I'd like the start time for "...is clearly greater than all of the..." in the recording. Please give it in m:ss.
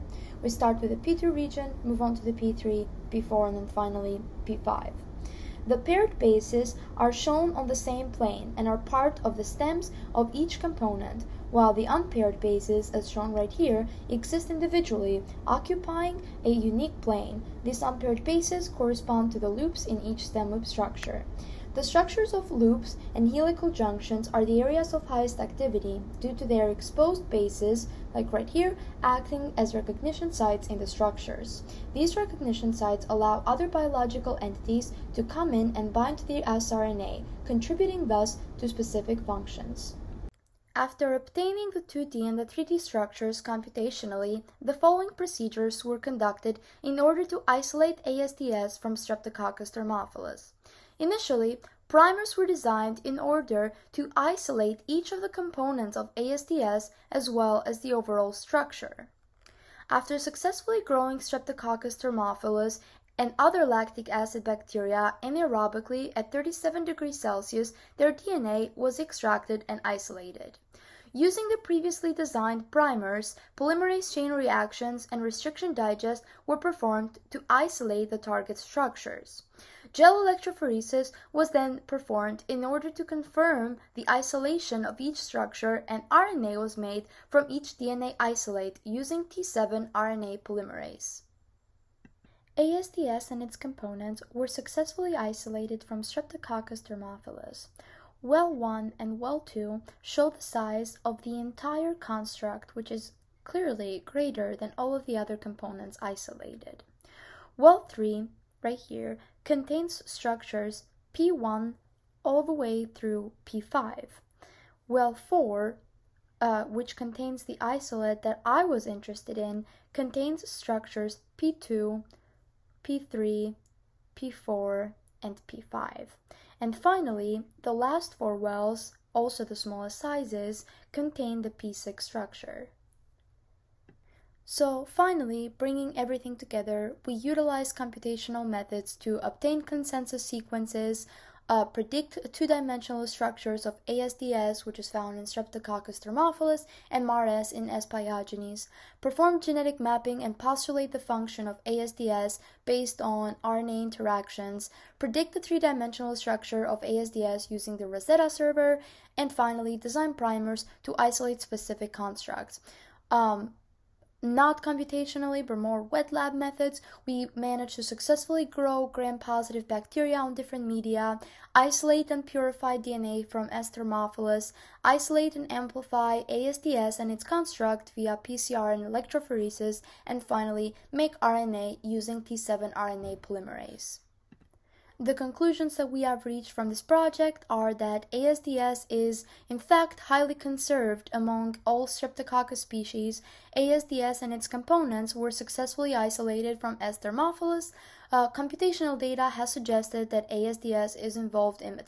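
1:42.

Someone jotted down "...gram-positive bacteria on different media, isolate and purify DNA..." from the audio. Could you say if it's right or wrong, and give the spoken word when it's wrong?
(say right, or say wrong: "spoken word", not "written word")
right.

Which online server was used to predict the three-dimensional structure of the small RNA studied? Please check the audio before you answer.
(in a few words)
Rosetta.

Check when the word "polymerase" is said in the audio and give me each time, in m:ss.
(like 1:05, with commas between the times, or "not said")
1:13, 1:30, 3:03.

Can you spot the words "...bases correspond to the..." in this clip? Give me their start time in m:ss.
0:18.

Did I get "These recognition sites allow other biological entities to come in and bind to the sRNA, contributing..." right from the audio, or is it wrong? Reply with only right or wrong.
right.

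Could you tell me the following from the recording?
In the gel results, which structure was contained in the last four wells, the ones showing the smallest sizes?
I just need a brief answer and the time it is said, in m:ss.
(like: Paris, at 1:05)
P6, at 2:11.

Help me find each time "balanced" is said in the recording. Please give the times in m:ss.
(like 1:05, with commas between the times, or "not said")
not said.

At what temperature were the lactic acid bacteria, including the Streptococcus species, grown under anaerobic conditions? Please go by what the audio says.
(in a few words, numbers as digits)
37 degrees Celsius.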